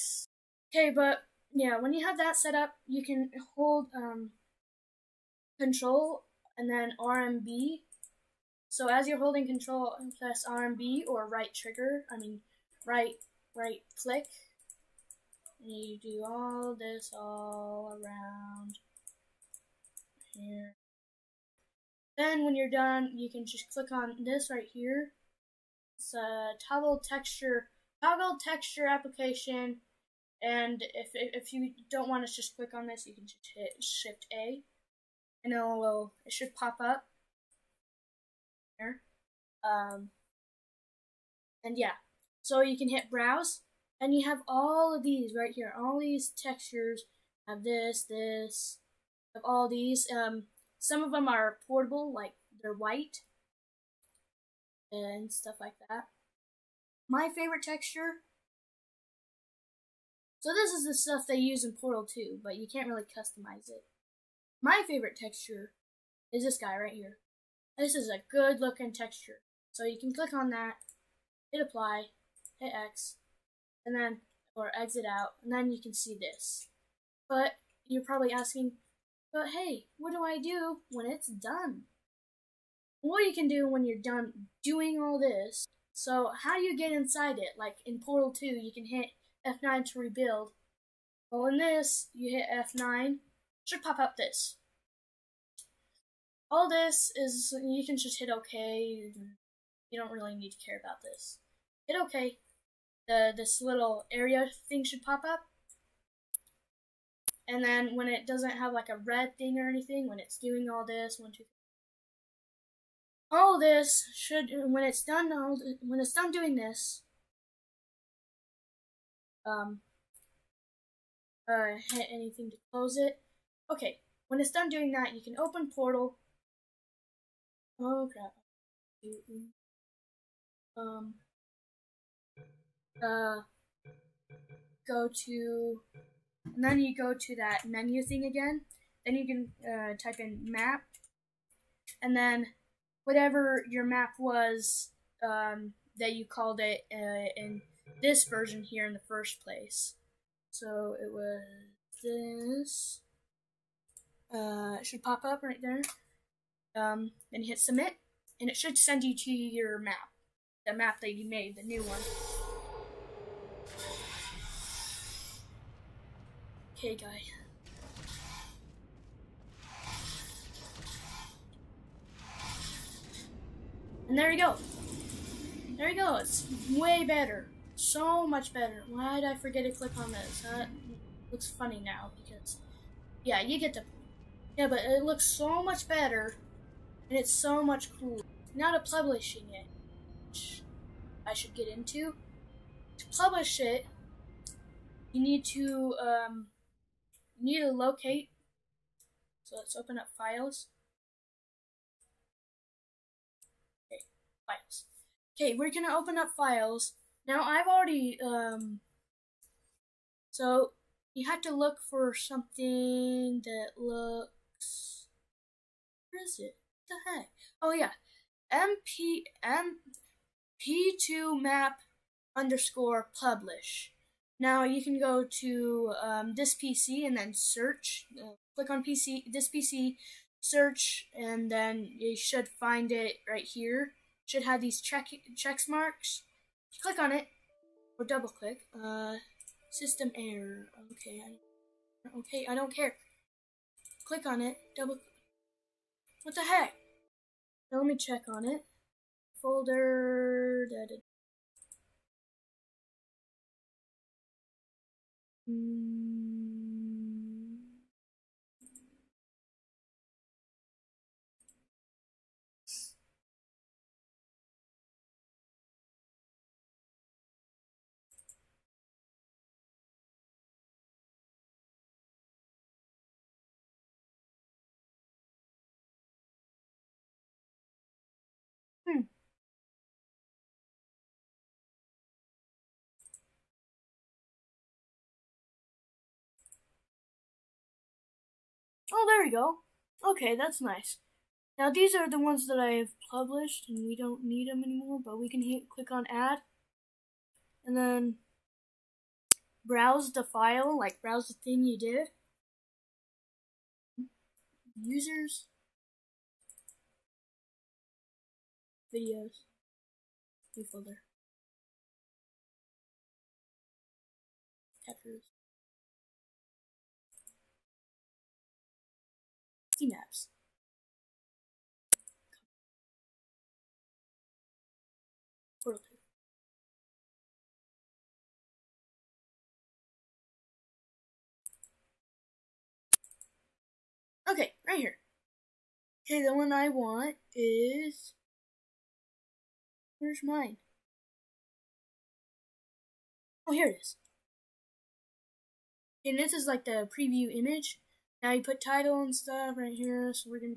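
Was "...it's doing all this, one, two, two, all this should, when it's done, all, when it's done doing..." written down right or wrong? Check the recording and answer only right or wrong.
wrong.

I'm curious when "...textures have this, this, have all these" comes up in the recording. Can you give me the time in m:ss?
0:46.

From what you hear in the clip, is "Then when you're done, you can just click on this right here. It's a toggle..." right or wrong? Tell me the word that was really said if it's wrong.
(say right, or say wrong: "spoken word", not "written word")
right.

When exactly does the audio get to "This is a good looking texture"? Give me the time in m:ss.
1:07.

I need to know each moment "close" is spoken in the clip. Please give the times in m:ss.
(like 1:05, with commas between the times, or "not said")
2:02.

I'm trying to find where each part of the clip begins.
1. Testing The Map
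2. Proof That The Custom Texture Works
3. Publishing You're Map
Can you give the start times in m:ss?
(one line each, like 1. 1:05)
1. 1:16
2. 2:47
3. 3:08.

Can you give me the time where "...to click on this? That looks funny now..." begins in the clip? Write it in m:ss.
2:59.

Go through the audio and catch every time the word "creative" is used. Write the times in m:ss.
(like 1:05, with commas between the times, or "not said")
not said.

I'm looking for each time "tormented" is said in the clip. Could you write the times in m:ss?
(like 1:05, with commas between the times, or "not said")
not said.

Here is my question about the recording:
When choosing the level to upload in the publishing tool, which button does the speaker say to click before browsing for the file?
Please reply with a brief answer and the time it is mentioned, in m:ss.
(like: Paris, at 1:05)
add, at 4:56.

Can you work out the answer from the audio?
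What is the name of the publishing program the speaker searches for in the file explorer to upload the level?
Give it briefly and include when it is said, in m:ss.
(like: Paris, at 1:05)
MP P2 map_publish, at 3:39.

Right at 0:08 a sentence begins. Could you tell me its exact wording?
So as you're holding control and press RMB or right trigger, I mean right, right click.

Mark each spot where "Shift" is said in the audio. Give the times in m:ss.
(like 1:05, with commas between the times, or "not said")
0:33.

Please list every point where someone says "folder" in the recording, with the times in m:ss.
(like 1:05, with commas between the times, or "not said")
4:09, 5:10.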